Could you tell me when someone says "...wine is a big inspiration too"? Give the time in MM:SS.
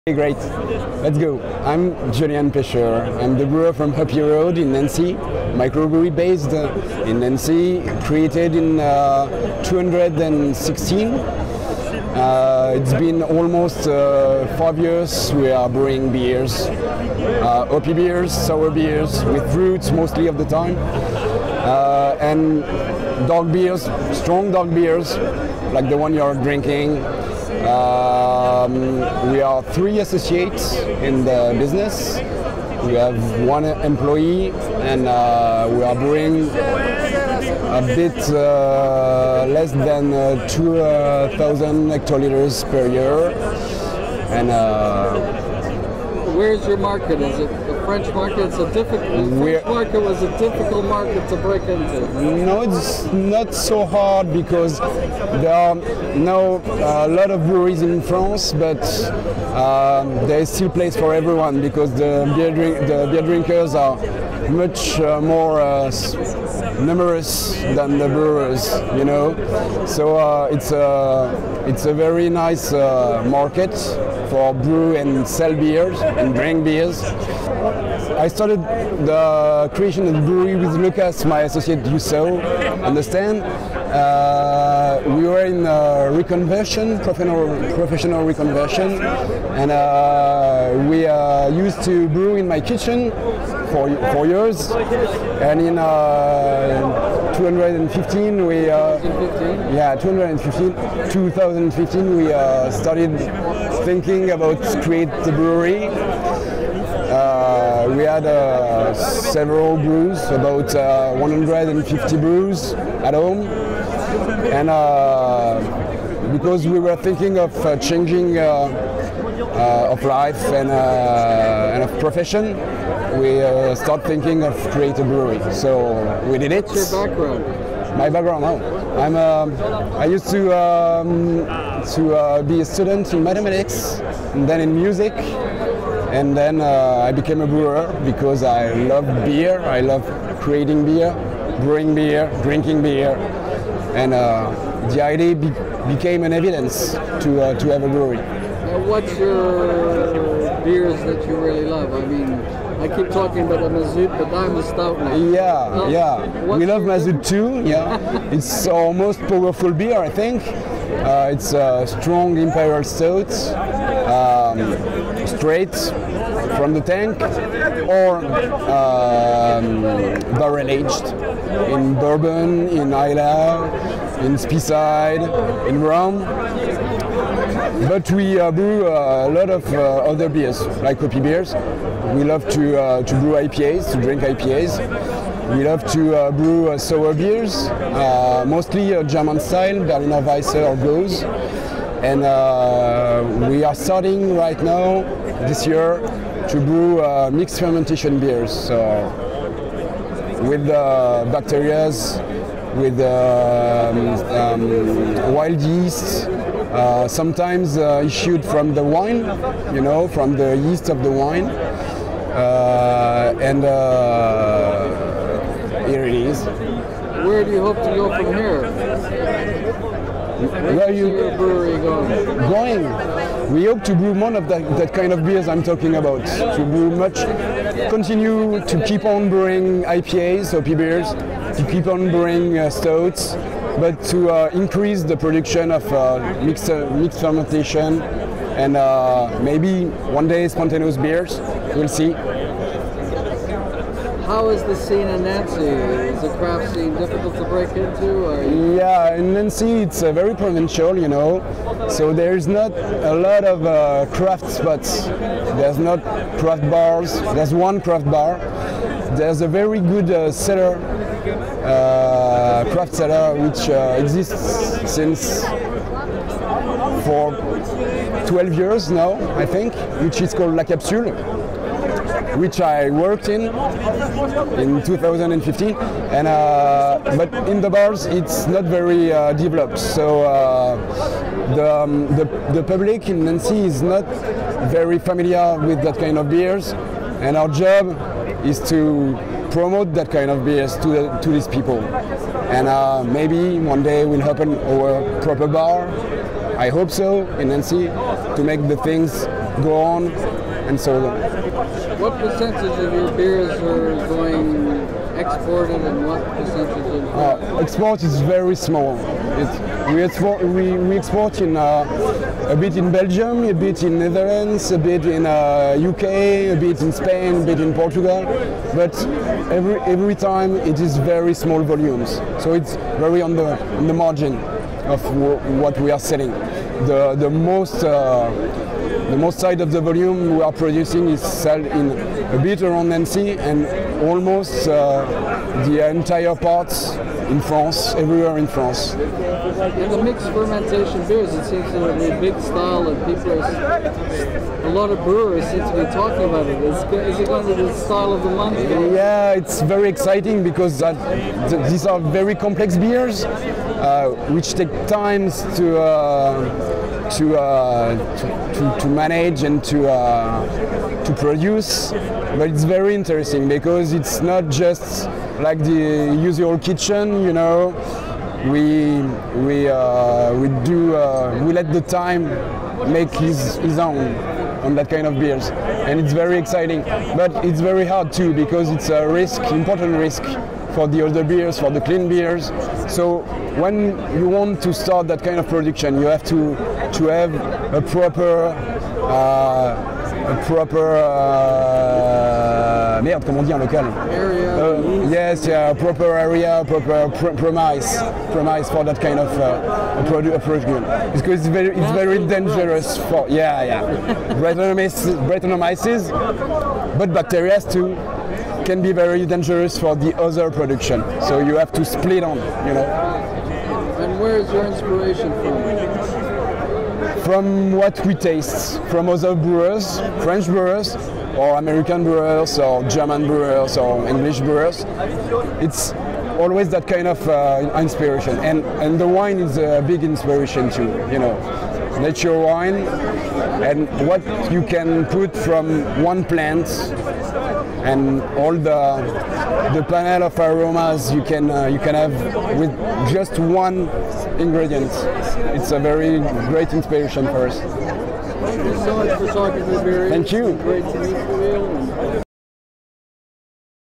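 07:09.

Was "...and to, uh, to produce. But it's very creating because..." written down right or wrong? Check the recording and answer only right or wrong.
wrong.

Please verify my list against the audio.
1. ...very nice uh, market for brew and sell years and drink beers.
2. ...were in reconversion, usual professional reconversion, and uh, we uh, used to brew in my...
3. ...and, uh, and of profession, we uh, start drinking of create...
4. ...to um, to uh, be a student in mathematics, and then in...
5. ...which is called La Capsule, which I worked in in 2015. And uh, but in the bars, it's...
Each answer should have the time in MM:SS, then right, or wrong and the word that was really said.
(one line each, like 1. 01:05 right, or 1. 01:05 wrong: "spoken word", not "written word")
1. 01:11 wrong: "beers", not "years"
2. 01:25 wrong: "professional", not "usual"
3. 02:00 wrong: "thinking", not "drinking"
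4. 02:10 right
5. 04:30 right.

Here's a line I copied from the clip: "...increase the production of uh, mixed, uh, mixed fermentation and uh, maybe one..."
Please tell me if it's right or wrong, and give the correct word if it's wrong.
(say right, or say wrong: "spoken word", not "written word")
right.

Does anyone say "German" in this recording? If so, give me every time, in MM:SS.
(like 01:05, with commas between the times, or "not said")
03:09, 07:02.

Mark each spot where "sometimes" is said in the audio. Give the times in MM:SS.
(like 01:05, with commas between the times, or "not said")
03:27.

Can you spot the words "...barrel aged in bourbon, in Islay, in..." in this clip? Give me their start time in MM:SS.
02:50.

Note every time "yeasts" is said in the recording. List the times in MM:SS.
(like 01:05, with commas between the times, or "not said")
03:25, 03:30.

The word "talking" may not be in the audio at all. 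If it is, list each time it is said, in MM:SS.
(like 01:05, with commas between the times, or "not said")
02:33, 03:45, 05:45.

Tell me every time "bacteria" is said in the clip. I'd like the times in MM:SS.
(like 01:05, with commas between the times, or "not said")
03:20, 06:47.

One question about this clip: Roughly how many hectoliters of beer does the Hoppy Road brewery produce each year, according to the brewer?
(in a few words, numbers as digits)
2,000 hectoliters.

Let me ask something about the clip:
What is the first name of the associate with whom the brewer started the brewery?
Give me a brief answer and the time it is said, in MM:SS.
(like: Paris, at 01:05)
Lucas, at 01:20.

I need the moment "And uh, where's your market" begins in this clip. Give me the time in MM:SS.
00:44.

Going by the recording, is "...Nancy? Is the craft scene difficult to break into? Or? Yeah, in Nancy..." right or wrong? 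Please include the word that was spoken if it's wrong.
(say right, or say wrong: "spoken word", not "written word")
right.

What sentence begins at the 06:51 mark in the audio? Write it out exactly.
So you have to split on, you know.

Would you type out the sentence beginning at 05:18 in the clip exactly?
But every every time it is very small volumes, so it's very on the on the margin of what we are selling.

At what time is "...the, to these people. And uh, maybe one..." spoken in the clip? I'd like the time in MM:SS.
04:50.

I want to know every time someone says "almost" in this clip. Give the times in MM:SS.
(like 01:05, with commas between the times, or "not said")
00:13, 05:34.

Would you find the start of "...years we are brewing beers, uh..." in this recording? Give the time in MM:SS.
00:14.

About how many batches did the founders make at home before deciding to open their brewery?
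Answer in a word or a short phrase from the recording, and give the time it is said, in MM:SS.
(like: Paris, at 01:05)
150, at 01:51.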